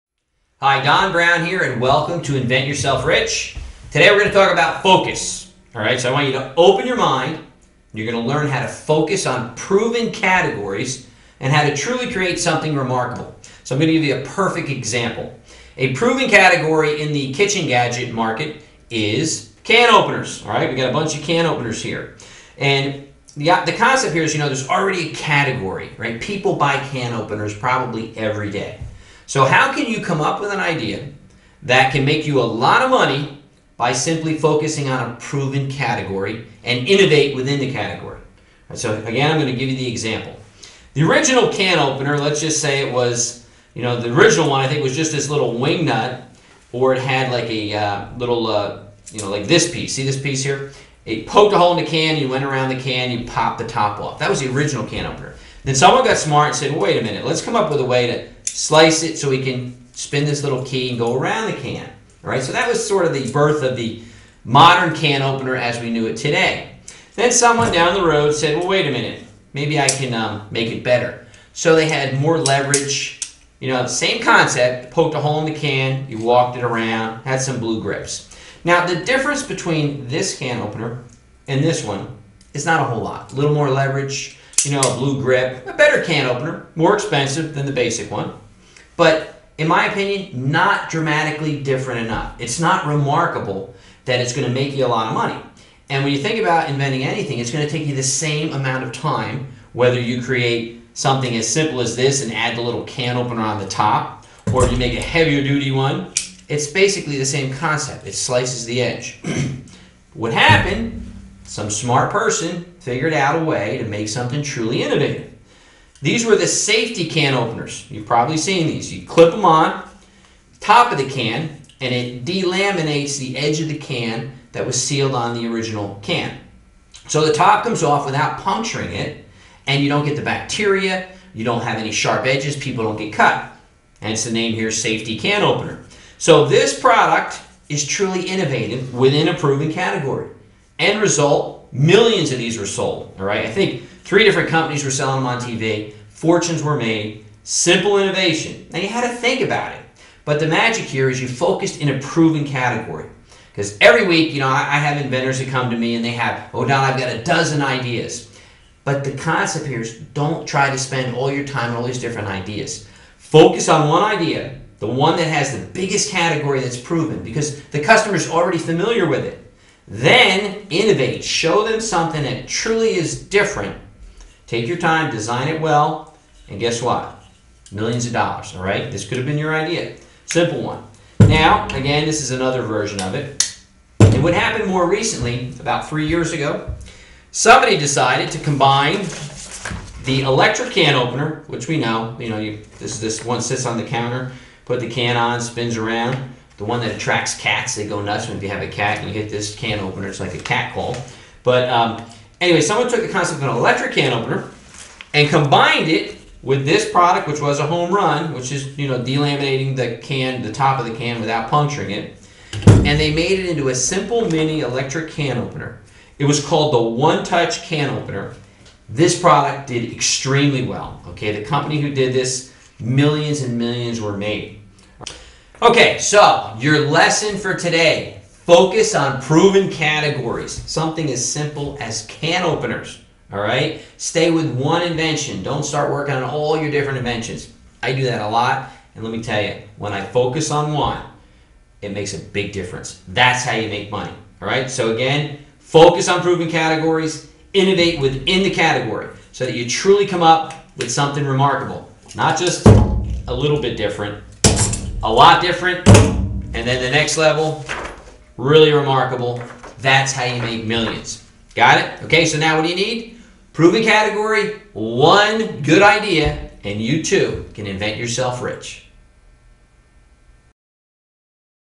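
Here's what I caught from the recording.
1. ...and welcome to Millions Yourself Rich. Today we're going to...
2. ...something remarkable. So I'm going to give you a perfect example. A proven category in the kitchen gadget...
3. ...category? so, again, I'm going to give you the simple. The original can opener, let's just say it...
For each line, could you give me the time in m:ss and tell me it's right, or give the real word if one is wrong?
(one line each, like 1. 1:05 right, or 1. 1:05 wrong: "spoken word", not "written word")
1. 0:01 wrong: "Invent", not "Millions"
2. 0:12 right
3. 0:37 wrong: "example", not "simple".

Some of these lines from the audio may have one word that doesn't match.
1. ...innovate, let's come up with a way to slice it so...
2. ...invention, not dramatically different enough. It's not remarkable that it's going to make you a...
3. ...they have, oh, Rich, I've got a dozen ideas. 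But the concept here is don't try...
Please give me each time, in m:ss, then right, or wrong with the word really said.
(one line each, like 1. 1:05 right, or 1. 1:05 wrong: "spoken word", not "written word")
1. 0:57 wrong: "minute", not "innovate"
2. 1:29 wrong: "opinion", not "invention"
3. 2:36 wrong: "Don", not "Rich".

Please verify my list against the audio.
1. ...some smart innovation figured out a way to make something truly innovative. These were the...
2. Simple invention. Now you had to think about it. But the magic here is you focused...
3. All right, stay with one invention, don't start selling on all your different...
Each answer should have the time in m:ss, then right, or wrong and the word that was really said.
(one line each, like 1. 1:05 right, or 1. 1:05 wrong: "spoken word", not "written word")
1. 1:51 wrong: "person", not "innovation"
2. 2:27 wrong: "innovation", not "invention"
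3. 3:53 wrong: "working", not "selling".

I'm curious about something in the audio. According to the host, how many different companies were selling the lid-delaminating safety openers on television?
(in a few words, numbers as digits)
3.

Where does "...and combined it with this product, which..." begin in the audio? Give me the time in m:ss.
3:25.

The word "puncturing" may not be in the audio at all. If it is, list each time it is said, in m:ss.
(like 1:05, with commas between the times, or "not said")
2:08, 3:31.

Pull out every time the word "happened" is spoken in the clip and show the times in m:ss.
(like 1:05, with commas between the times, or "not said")
1:50, 3:04.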